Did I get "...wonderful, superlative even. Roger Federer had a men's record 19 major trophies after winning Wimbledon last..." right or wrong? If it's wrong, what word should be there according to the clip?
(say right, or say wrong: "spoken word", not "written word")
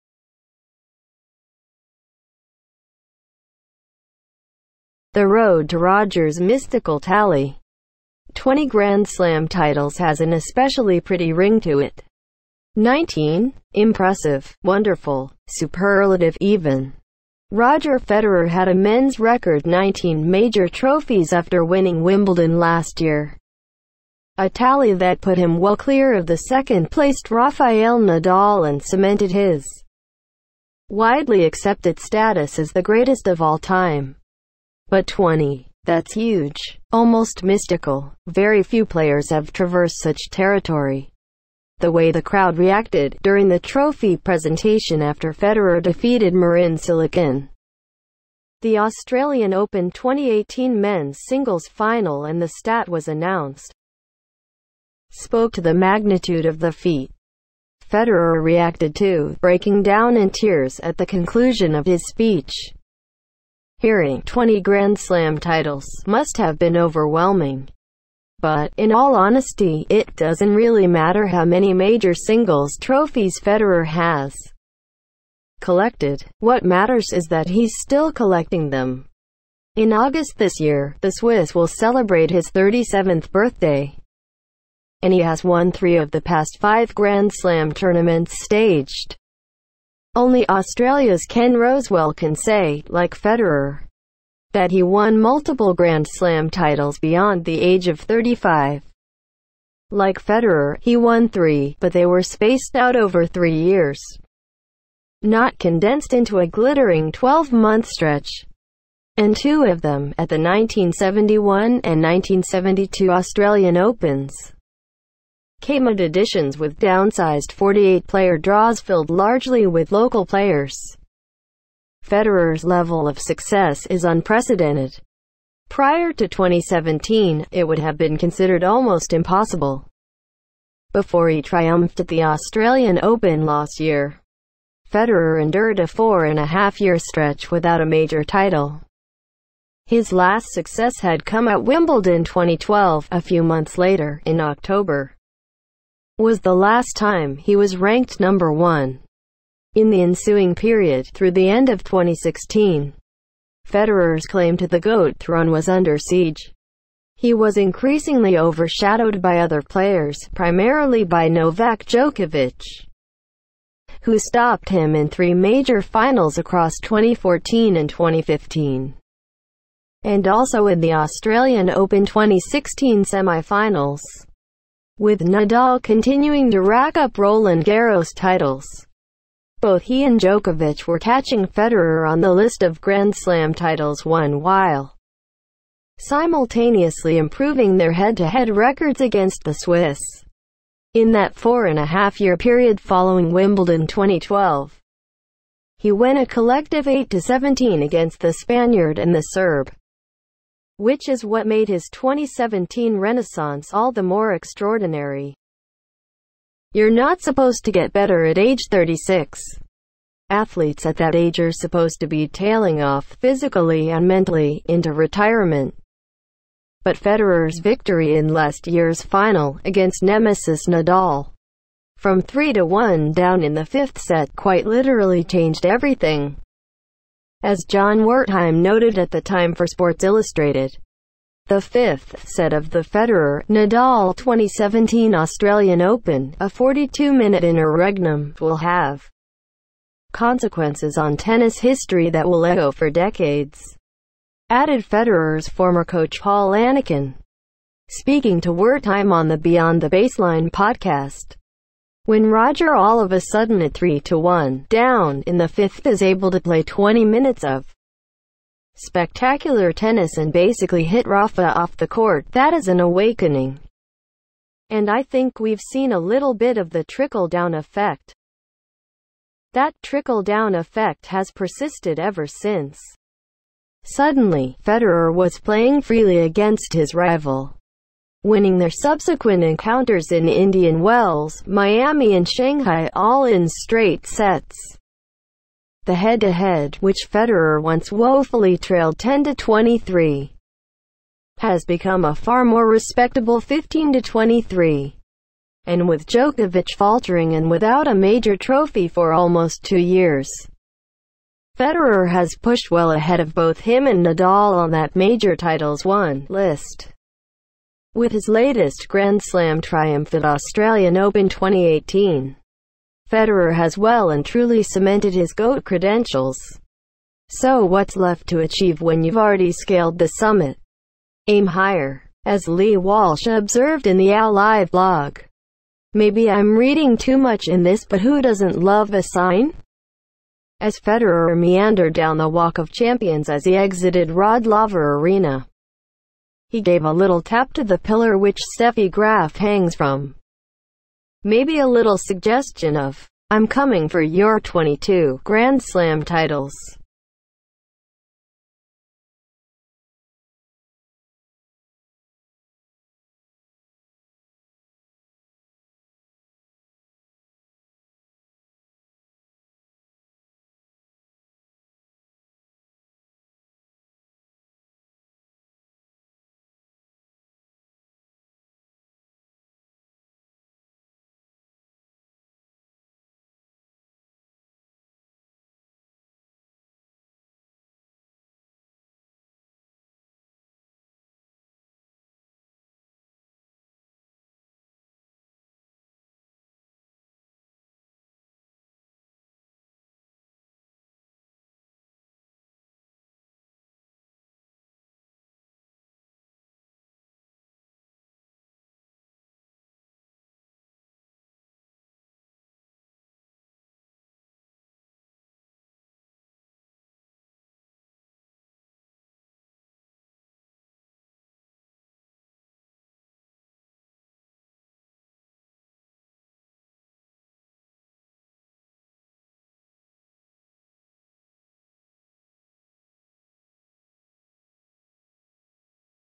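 right.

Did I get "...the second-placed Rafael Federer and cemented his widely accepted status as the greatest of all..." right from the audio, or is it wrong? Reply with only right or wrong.
wrong.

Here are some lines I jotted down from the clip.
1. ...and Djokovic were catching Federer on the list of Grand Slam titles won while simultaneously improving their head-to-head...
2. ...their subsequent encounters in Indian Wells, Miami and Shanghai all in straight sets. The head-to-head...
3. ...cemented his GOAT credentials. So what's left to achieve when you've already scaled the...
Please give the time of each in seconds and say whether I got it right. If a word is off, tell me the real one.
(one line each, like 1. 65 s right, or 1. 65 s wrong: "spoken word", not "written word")
1. 180 s right
2. 278 s right
3. 314 s right.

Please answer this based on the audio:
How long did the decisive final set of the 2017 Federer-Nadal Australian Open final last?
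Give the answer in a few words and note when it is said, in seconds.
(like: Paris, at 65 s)
42 minutes, at 236 s.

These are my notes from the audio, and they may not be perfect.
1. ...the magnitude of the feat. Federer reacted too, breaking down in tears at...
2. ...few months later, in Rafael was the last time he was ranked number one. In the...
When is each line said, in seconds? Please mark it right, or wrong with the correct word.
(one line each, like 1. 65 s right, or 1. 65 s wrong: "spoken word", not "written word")
1. 55 s right
2. 143 s wrong: "October", not "Rafael".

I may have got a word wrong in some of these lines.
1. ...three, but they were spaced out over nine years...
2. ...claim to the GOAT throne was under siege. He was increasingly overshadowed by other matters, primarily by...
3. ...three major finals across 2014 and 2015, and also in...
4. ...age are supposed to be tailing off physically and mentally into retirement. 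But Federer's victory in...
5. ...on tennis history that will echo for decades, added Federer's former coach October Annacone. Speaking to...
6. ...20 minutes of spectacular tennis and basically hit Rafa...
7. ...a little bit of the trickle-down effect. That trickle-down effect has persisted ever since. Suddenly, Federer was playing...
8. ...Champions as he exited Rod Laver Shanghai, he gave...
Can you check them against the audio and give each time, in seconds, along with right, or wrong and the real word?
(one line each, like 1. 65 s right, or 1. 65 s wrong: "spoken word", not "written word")
1. 101 s wrong: "three", not "nine"
2. 154 s wrong: "players", not "matters"
3. 165 s right
4. 211 s right
5. 240 s wrong: "Paul", not "October"
6. 256 s right
7. 265 s right
8. 332 s wrong: "Arena", not "Shanghai".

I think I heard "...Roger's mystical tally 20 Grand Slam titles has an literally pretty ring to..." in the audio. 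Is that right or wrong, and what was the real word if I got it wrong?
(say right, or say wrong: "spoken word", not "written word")
wrong: "especially", not "literally".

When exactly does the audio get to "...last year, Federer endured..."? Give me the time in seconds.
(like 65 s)
133 s.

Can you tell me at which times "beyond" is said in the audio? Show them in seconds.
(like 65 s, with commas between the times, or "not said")
96 s, 249 s.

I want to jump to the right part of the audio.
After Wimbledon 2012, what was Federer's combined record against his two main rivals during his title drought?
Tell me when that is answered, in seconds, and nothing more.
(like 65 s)
196 s.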